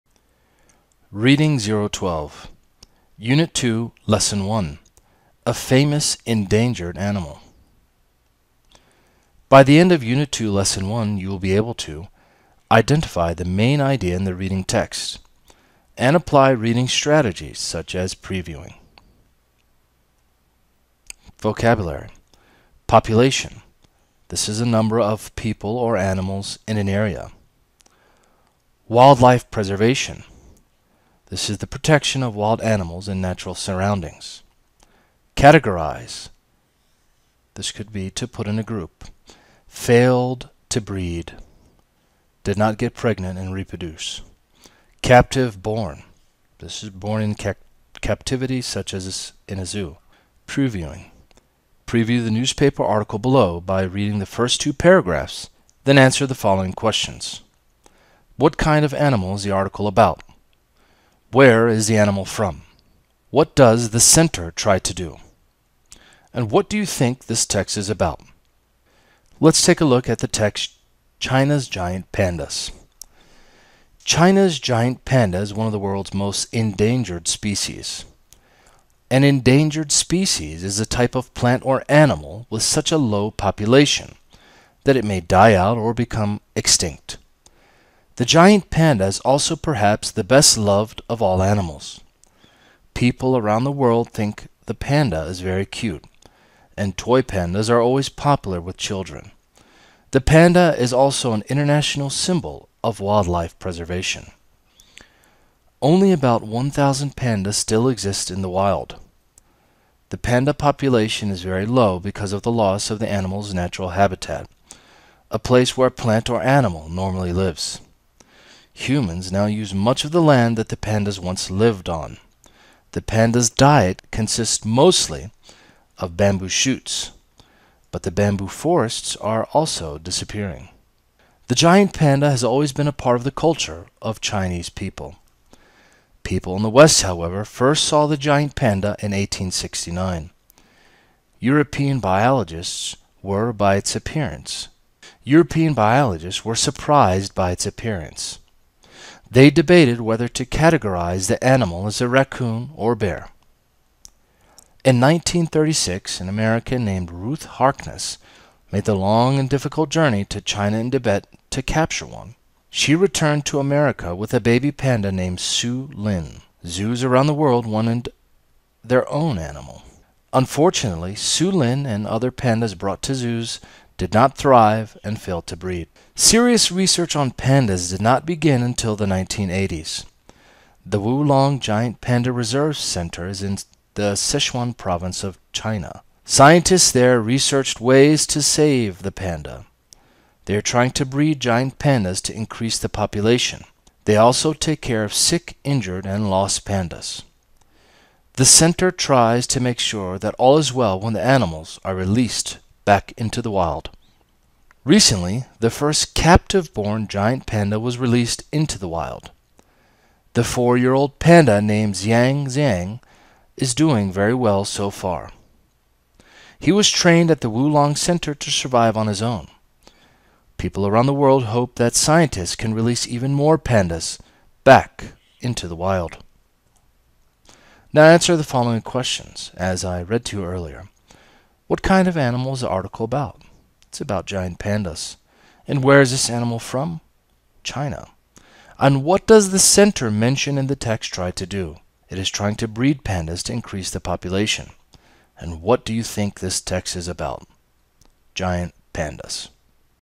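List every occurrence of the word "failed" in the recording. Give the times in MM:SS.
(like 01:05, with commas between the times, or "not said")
00:39, 02:55.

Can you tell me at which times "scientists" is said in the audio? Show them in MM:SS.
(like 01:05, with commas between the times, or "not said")
03:06, 03:41.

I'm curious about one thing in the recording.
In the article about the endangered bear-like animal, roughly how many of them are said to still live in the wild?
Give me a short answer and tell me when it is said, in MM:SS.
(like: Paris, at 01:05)
1,000, at 01:46.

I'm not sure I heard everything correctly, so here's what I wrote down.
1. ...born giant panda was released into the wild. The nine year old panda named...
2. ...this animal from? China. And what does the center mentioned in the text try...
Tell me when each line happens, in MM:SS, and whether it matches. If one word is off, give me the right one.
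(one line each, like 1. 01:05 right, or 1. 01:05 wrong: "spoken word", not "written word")
1. 03:26 wrong: "four", not "nine"
2. 03:56 right.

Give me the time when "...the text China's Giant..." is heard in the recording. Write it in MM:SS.
01:10.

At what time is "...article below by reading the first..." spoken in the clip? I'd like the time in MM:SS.
00:52.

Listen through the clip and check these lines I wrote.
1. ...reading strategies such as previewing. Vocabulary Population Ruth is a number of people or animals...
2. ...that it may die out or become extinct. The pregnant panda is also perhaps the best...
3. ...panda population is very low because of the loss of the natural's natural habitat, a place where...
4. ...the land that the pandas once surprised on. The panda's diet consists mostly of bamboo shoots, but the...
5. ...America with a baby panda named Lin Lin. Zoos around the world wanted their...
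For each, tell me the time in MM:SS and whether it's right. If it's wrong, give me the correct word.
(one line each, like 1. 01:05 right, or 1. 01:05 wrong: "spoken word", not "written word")
1. 00:16 wrong: "This", not "Ruth"
2. 01:24 wrong: "giant", not "pregnant"
3. 01:50 wrong: "animal", not "natural"
4. 02:00 wrong: "lived", not "surprised"
5. 02:43 wrong: "Sue", not "Lin".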